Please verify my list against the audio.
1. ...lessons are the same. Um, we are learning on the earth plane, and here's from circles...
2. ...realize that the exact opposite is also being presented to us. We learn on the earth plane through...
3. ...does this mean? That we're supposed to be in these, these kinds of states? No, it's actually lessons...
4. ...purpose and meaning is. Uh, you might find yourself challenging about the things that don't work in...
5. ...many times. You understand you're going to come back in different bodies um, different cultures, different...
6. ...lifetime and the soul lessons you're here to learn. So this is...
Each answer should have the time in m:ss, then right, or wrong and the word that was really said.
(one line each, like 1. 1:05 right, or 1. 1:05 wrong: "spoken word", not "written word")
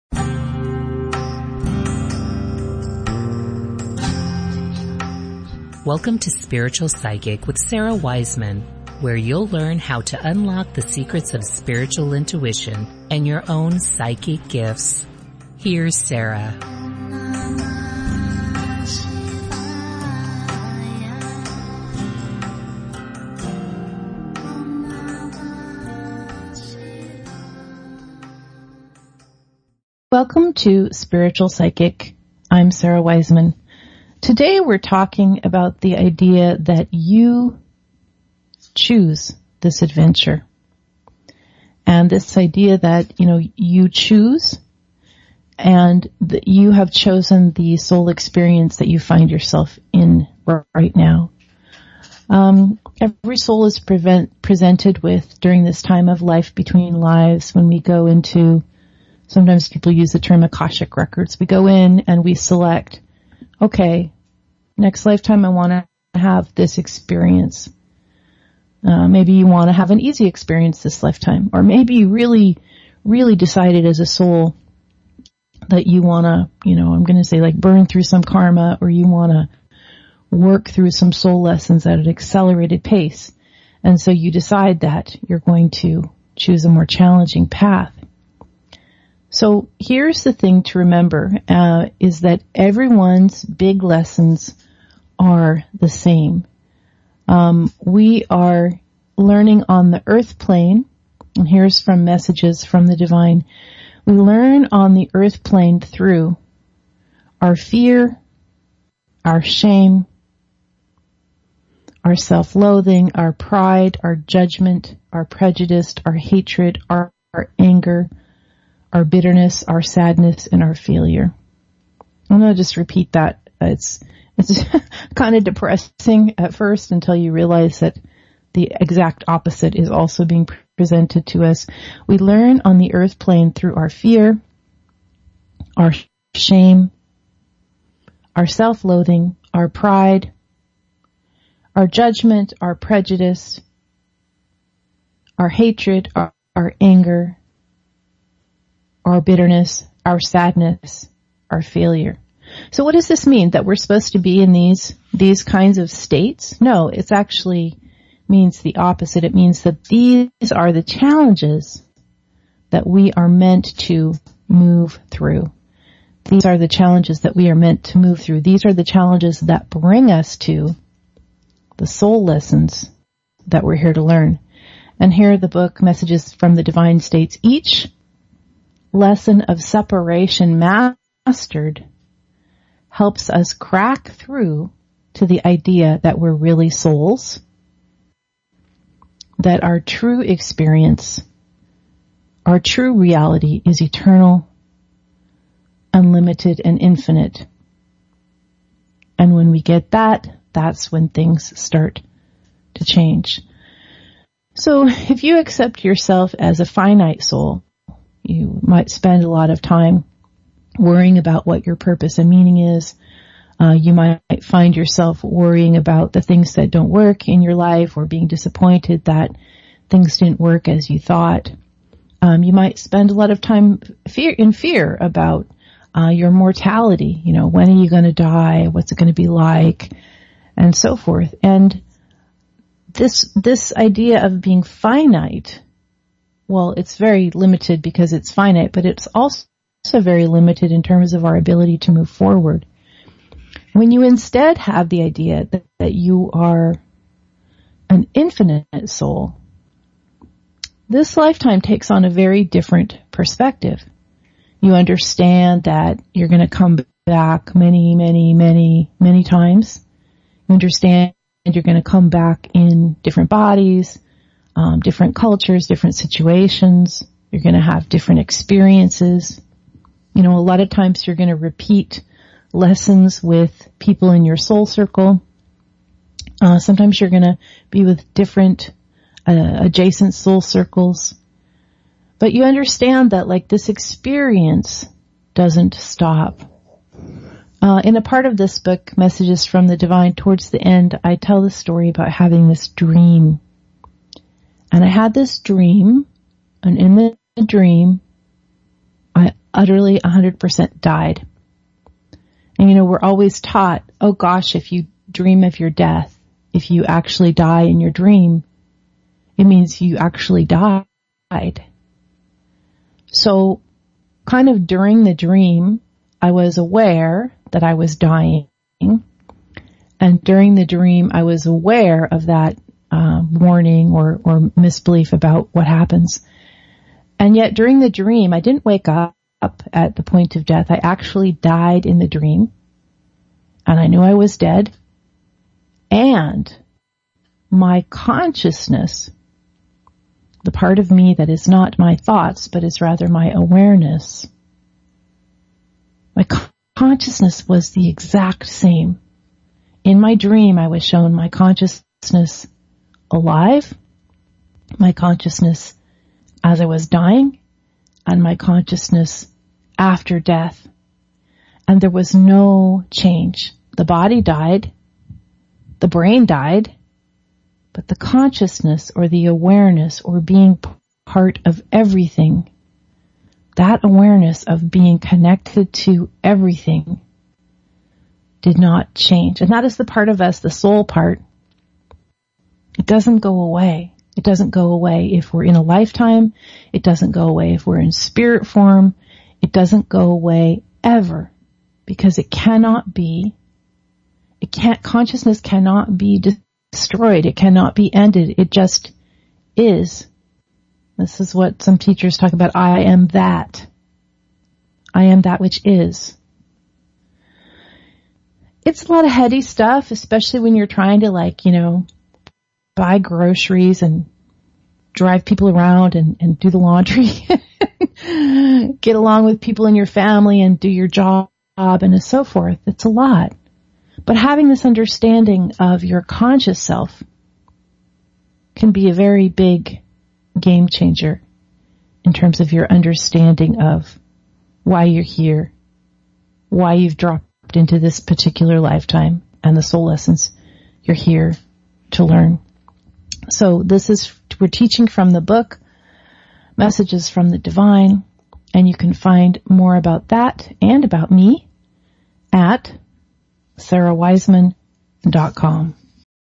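1. 1:33 wrong: "messages", not "circles"
2. 2:07 right
3. 2:32 wrong: "means", not "lessons"
4. 3:31 wrong: "worrying", not "challenging"
5. 4:18 right
6. 7:18 right.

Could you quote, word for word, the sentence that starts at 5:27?
And yet during the dream, I didn't wake up at the point of death.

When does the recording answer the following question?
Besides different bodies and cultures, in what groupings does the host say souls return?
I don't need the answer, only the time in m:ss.
4:40.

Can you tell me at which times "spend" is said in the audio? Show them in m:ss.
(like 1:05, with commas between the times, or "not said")
3:28, 3:42.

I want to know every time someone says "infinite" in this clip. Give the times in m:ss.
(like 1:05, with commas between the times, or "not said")
3:16, 4:08.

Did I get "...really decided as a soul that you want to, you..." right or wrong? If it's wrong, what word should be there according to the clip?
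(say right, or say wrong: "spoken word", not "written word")
right.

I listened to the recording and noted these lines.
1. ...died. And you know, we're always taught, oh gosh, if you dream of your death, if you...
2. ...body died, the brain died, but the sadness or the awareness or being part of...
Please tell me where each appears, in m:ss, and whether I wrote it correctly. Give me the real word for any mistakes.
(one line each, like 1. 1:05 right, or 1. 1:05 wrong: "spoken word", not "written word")
1. 5:00 right
2. 6:03 wrong: "consciousness", not "sadness".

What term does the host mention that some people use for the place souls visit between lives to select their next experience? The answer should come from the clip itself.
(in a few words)
Akashic records.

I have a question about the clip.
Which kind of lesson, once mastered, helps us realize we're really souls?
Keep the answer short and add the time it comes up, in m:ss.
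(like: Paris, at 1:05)
separation, at 2:59.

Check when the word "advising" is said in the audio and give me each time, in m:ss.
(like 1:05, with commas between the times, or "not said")
not said.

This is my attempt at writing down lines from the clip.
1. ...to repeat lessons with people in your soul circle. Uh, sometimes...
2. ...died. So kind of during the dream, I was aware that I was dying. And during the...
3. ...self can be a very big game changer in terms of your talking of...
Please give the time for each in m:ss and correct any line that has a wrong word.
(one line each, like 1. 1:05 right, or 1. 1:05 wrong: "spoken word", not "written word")
1. 4:31 right
2. 5:10 right
3. 7:06 wrong: "understanding", not "talking".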